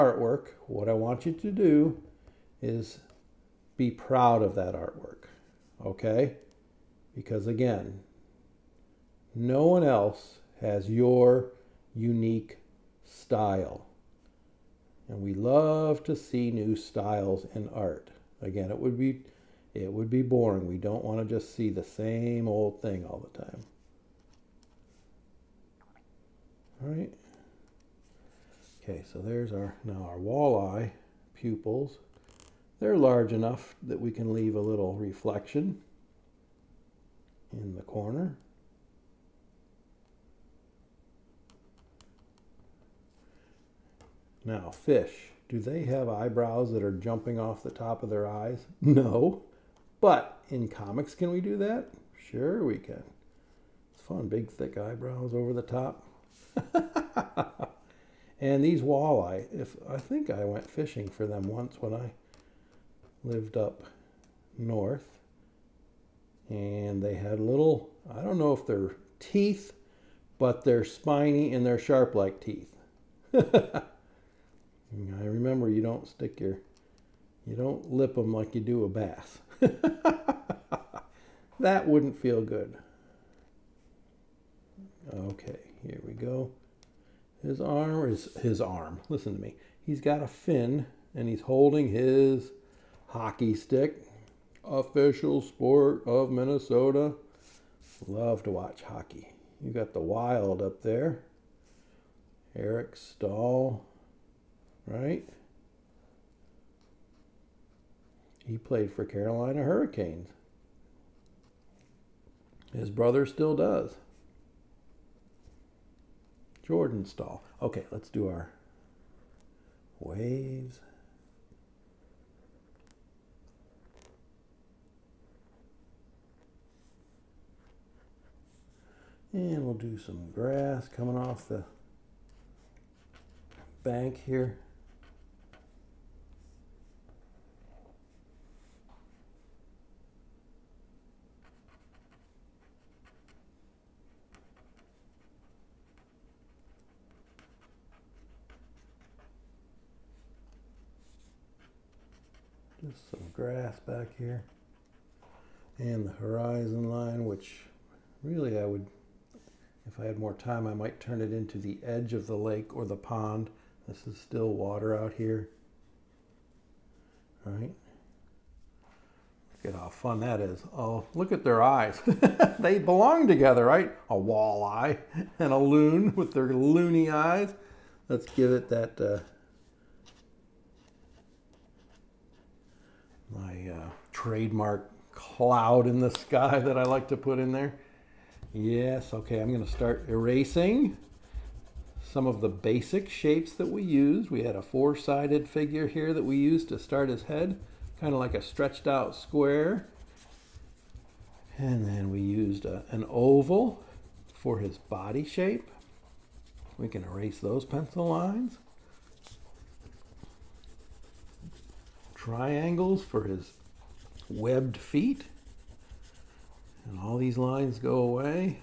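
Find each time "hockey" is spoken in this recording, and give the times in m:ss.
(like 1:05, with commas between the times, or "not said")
1:33, 1:38.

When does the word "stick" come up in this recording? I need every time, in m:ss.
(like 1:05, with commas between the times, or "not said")
1:16, 1:33.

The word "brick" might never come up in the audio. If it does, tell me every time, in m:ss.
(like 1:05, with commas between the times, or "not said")
not said.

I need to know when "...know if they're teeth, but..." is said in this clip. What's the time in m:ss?
1:08.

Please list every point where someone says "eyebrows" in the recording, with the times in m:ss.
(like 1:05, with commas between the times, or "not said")
0:46, 0:54.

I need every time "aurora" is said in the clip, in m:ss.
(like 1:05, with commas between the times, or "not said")
not said.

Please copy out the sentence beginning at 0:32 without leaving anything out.
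They're large enough that we can leave a little reflection in the corner.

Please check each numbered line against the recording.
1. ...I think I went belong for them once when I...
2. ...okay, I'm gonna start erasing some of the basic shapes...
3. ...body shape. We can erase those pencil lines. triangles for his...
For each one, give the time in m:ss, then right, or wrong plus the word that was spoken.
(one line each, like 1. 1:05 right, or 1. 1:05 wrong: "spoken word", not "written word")
1. 0:59 wrong: "fishing", not "belong"
2. 3:09 right
3. 3:24 right.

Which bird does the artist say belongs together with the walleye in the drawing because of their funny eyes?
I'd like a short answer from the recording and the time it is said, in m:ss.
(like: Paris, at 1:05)
A loon, at 2:55.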